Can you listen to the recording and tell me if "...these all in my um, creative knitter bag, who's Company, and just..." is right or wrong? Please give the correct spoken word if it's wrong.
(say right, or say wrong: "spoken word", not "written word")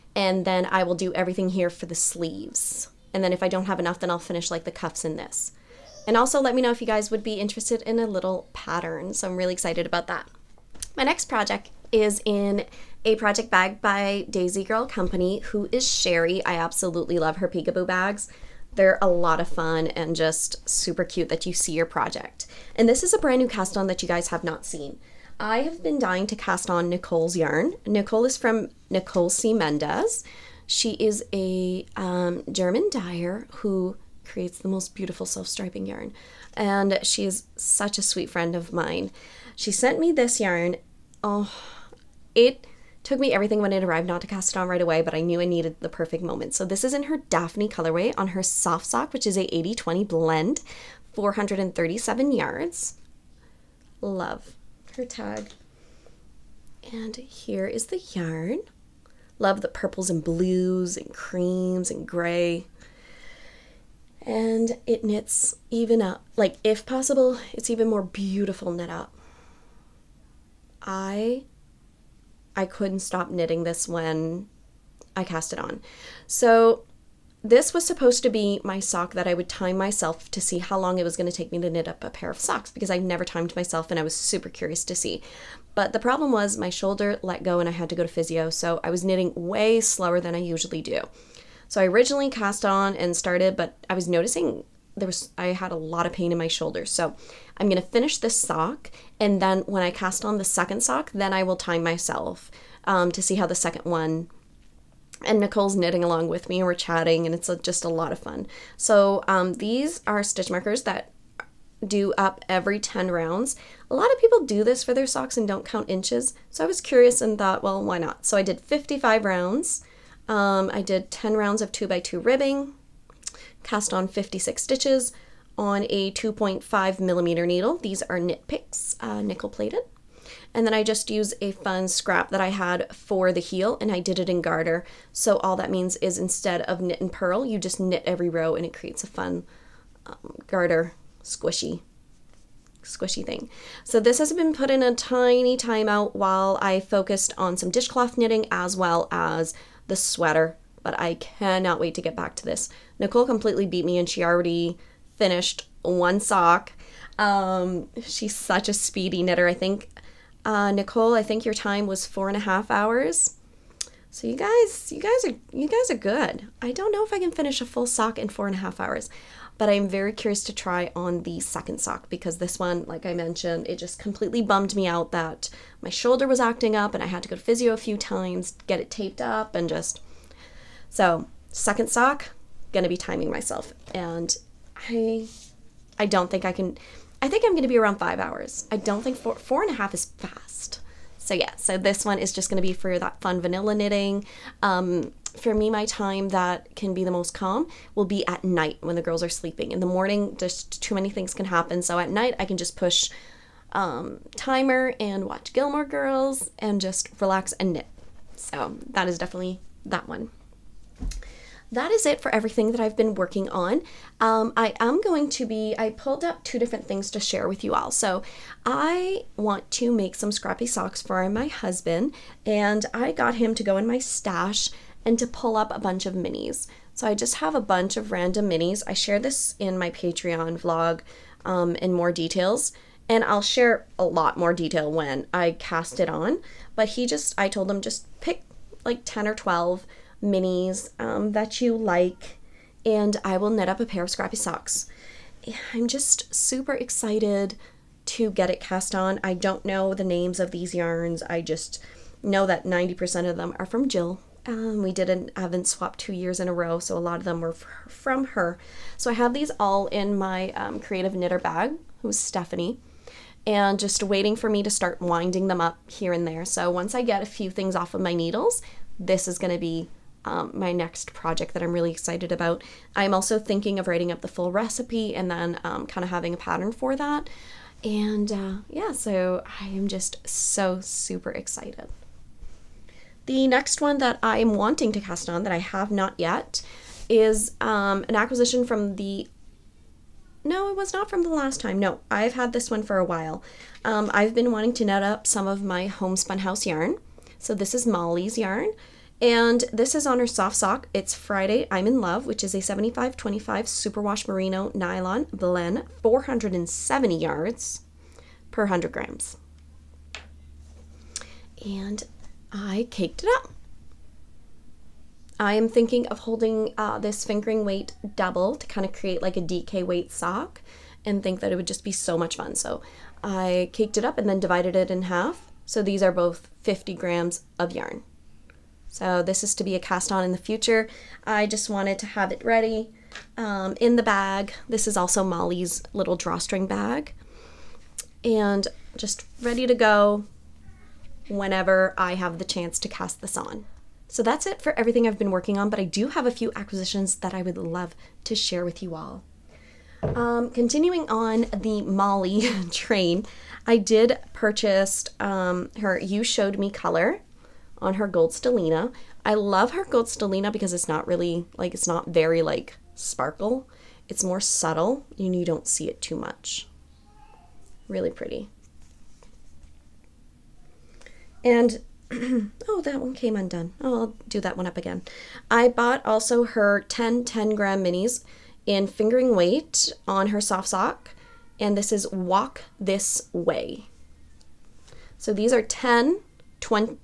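wrong: "Stephanie", not "Company".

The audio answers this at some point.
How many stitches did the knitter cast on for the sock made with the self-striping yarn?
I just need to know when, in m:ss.
2:04.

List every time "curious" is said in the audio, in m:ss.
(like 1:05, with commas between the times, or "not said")
1:24, 1:56, 2:50.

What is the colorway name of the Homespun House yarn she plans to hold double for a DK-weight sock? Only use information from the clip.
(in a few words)
Friday I'm in Love.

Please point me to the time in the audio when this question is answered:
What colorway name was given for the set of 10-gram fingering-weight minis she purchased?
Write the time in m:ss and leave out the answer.
6:22.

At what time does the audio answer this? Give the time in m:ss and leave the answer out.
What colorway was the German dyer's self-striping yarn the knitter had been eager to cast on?
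0:47.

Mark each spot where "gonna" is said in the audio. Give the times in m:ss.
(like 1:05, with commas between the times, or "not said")
3:02, 3:07, 3:12.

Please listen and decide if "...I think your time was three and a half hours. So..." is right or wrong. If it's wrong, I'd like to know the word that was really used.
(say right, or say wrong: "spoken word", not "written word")
wrong: "four", not "three".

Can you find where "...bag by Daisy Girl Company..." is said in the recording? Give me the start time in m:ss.
0:13.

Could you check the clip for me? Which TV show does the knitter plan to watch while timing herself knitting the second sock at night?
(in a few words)
Gilmore Girls.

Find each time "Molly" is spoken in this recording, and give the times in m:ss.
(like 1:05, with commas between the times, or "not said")
4:57, 5:35, 5:51.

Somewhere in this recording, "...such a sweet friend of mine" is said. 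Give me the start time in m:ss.
0:37.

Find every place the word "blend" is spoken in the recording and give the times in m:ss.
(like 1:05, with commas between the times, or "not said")
0:50, 5:05.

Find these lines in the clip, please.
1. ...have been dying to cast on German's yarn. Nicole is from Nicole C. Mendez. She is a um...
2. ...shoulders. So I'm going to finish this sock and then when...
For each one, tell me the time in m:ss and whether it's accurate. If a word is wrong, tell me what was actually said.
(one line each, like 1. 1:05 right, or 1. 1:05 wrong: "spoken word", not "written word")
1. 0:25 wrong: "Nicole", not "German"
2. 1:36 right.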